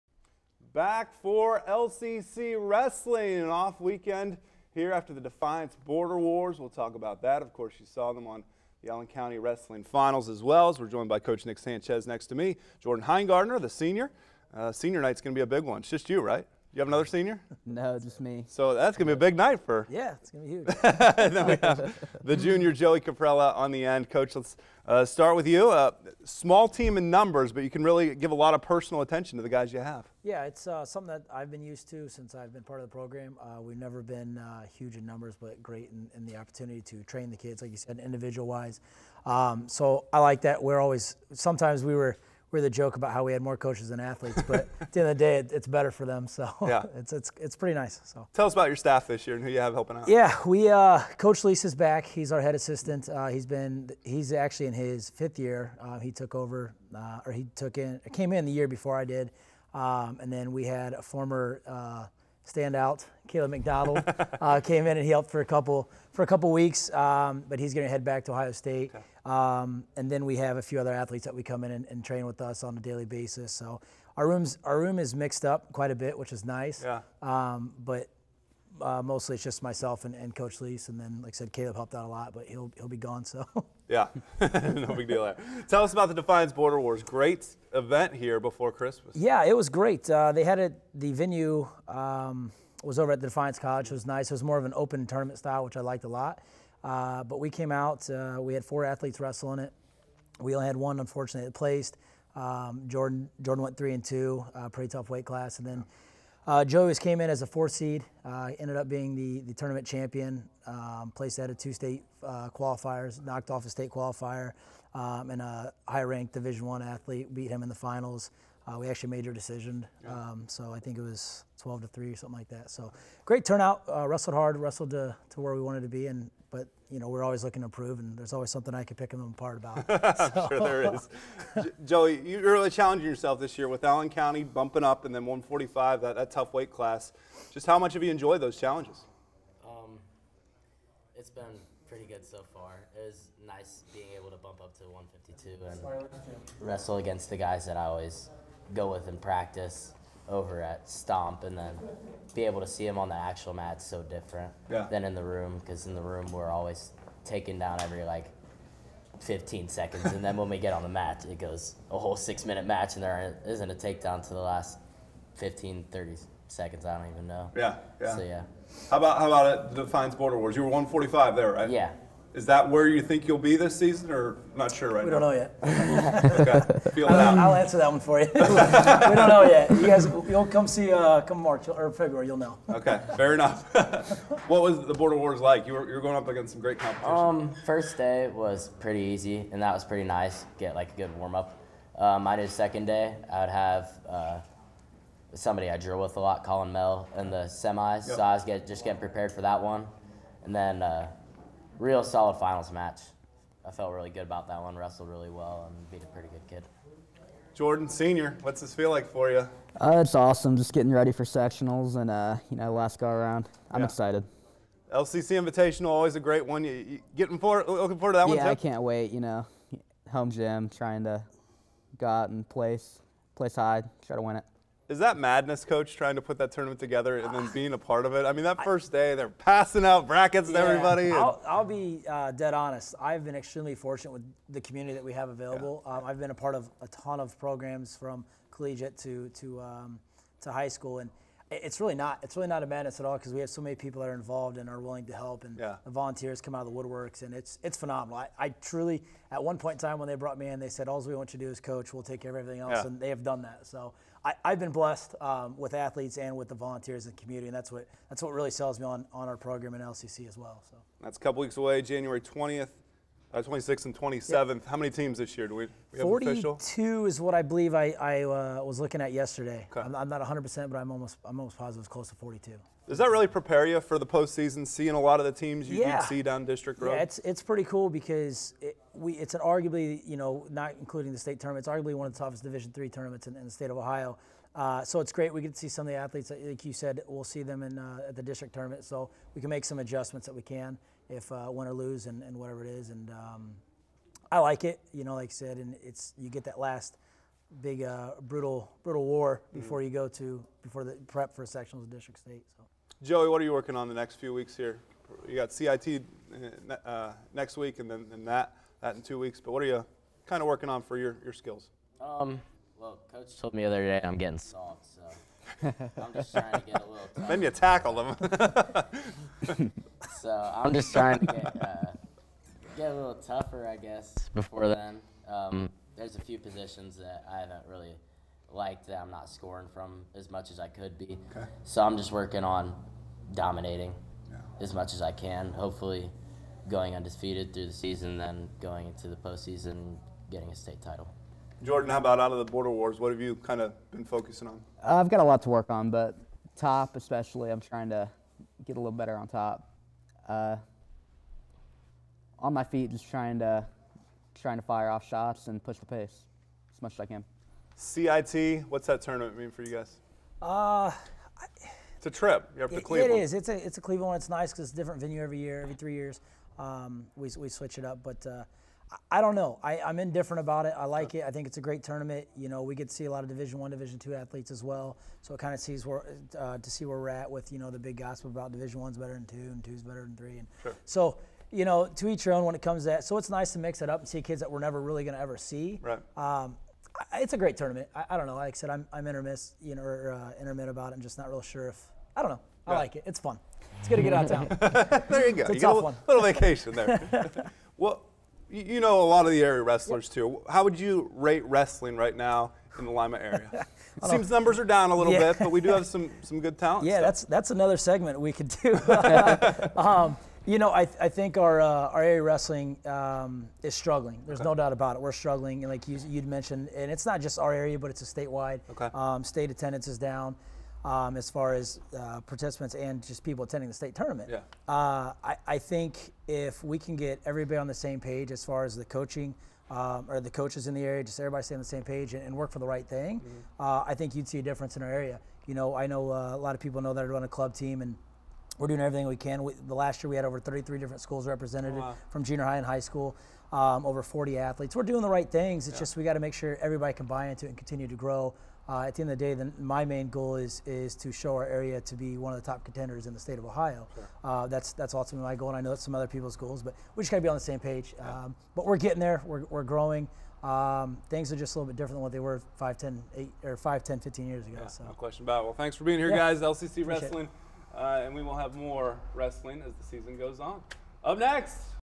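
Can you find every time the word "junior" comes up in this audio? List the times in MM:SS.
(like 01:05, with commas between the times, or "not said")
00:22, 07:22.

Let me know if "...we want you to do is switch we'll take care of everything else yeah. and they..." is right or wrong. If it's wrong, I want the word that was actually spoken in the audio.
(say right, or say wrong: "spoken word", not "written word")
wrong: "coach", not "switch".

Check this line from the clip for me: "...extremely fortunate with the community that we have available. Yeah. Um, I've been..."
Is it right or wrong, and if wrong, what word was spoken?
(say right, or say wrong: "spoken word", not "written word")
right.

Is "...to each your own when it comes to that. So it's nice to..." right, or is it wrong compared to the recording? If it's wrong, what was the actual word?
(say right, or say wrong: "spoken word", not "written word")
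right.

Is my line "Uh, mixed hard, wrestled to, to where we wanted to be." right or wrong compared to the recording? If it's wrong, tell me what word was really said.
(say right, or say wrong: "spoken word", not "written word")
wrong: "wrestled", not "mixed".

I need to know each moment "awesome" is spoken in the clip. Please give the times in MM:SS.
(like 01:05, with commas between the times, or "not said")
03:30.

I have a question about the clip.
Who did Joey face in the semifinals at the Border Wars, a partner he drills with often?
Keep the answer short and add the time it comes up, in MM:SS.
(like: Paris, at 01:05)
Colin Mel, at 03:16.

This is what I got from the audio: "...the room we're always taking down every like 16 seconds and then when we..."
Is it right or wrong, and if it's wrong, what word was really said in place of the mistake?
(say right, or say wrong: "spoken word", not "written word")
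wrong: "15", not "16".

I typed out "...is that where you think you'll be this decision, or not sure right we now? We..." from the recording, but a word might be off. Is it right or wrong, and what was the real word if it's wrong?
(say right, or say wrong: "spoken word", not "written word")
wrong: "season", not "decision".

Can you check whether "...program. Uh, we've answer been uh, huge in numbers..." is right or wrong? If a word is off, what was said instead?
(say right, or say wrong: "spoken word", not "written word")
wrong: "never", not "answer".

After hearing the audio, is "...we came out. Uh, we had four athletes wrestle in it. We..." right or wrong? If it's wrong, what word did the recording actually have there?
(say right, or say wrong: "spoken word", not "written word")
right.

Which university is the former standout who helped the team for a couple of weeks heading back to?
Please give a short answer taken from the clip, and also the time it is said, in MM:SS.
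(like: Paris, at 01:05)
Ohio State, at 01:08.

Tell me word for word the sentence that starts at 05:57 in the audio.
CIT, what's that tournament mean for you guys?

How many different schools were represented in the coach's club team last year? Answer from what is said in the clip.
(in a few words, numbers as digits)
33.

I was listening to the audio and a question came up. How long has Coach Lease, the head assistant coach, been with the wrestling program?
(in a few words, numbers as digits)
5th year.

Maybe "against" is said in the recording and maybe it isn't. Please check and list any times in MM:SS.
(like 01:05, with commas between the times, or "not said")
02:26, 03:06.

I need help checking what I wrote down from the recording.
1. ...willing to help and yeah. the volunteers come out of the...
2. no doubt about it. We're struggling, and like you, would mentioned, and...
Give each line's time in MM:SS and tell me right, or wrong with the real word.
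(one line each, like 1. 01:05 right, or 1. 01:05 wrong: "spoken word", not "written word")
1. 04:04 right
2. 06:54 right.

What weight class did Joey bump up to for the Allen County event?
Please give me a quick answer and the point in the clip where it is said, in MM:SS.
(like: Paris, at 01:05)
152, at 02:24.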